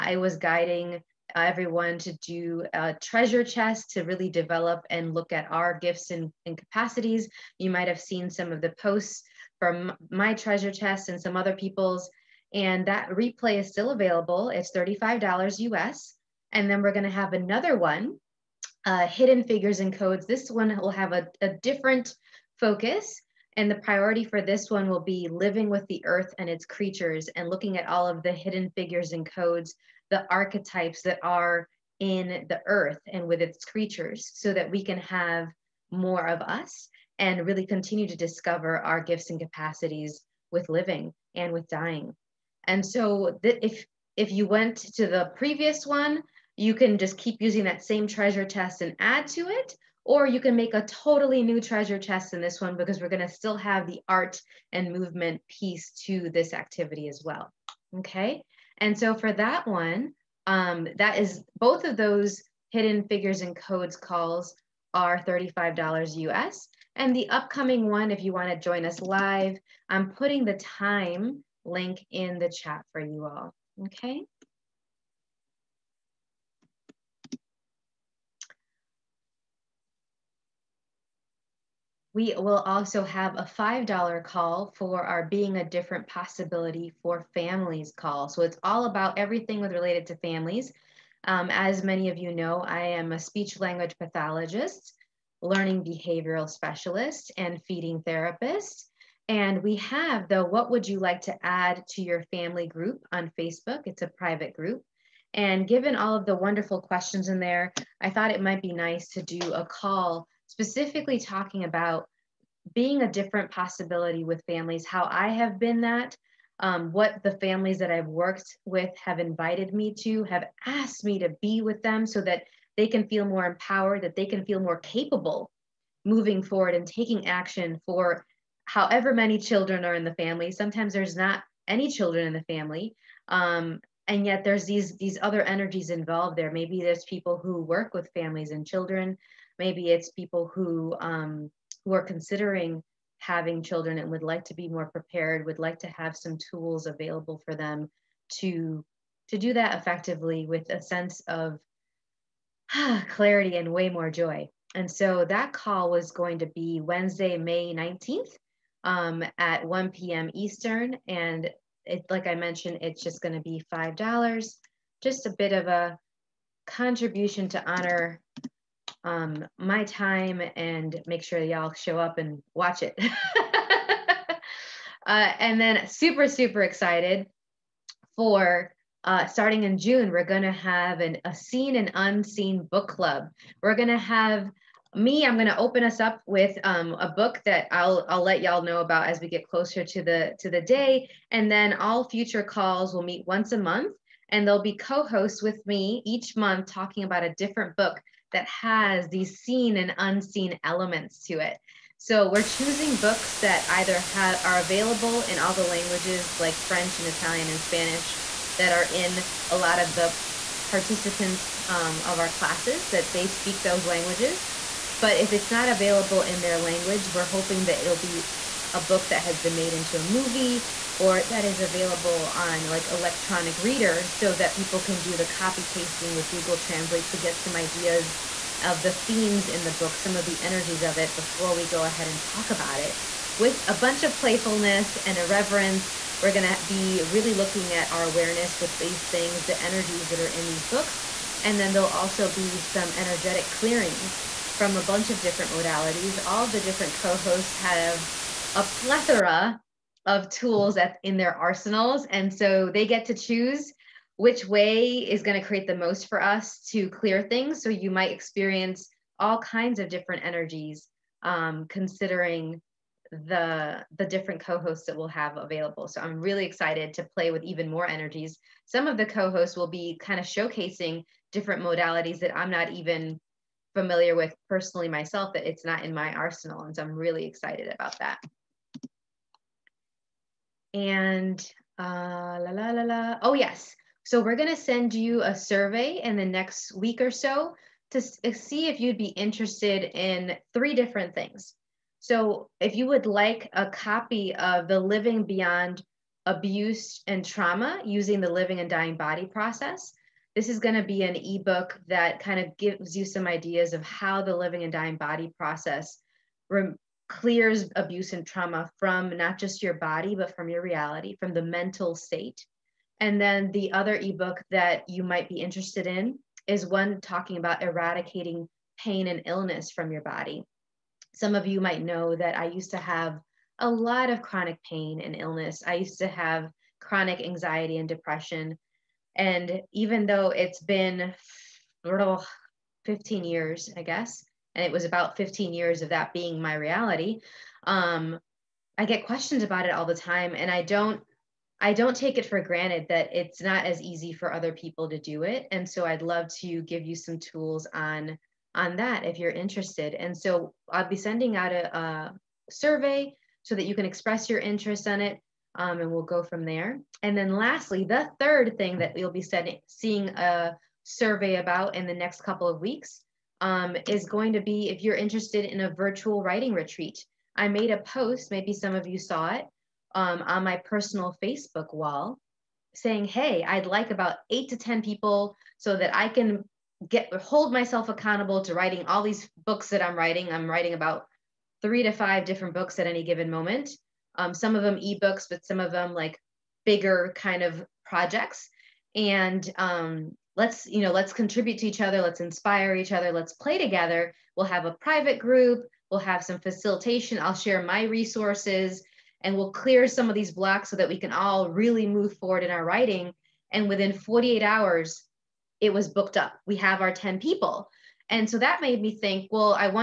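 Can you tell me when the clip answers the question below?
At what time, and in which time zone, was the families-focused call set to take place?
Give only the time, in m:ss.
2:39.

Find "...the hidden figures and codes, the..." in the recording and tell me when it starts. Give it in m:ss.
0:28.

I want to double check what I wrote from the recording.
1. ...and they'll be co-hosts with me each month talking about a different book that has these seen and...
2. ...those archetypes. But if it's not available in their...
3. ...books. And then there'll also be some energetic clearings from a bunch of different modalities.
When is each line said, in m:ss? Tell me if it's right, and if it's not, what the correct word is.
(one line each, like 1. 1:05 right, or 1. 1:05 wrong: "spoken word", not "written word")
1. 3:14 right
2. 3:33 wrong: "languages", not "archetypes"
3. 4:00 right.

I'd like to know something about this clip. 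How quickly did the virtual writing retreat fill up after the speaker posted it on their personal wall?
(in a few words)
48 hours.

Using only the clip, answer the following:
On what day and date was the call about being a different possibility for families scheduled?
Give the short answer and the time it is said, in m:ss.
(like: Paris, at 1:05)
Wednesday, May 19, at 2:36.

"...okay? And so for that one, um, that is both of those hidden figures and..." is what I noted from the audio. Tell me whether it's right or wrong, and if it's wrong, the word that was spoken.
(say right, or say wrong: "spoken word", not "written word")
right.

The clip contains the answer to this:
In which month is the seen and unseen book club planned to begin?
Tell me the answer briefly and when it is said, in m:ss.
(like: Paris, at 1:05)
June, at 2:59.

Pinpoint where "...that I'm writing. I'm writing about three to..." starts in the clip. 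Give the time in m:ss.
6:19.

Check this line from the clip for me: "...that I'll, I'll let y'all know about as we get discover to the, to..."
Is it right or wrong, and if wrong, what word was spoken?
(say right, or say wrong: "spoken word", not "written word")
wrong: "closer", not "discover".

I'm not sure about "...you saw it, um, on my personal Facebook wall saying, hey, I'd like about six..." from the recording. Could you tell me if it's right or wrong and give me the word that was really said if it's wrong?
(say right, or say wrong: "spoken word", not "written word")
wrong: "eight", not "six".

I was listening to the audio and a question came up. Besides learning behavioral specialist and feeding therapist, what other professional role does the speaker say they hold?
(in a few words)
speech language pathologist.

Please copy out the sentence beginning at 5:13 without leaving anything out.
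And then the other ebook that you might be interested in is one talking about eradicating pain and illness from your body.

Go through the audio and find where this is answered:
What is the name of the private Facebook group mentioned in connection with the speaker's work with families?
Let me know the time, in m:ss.
1:40.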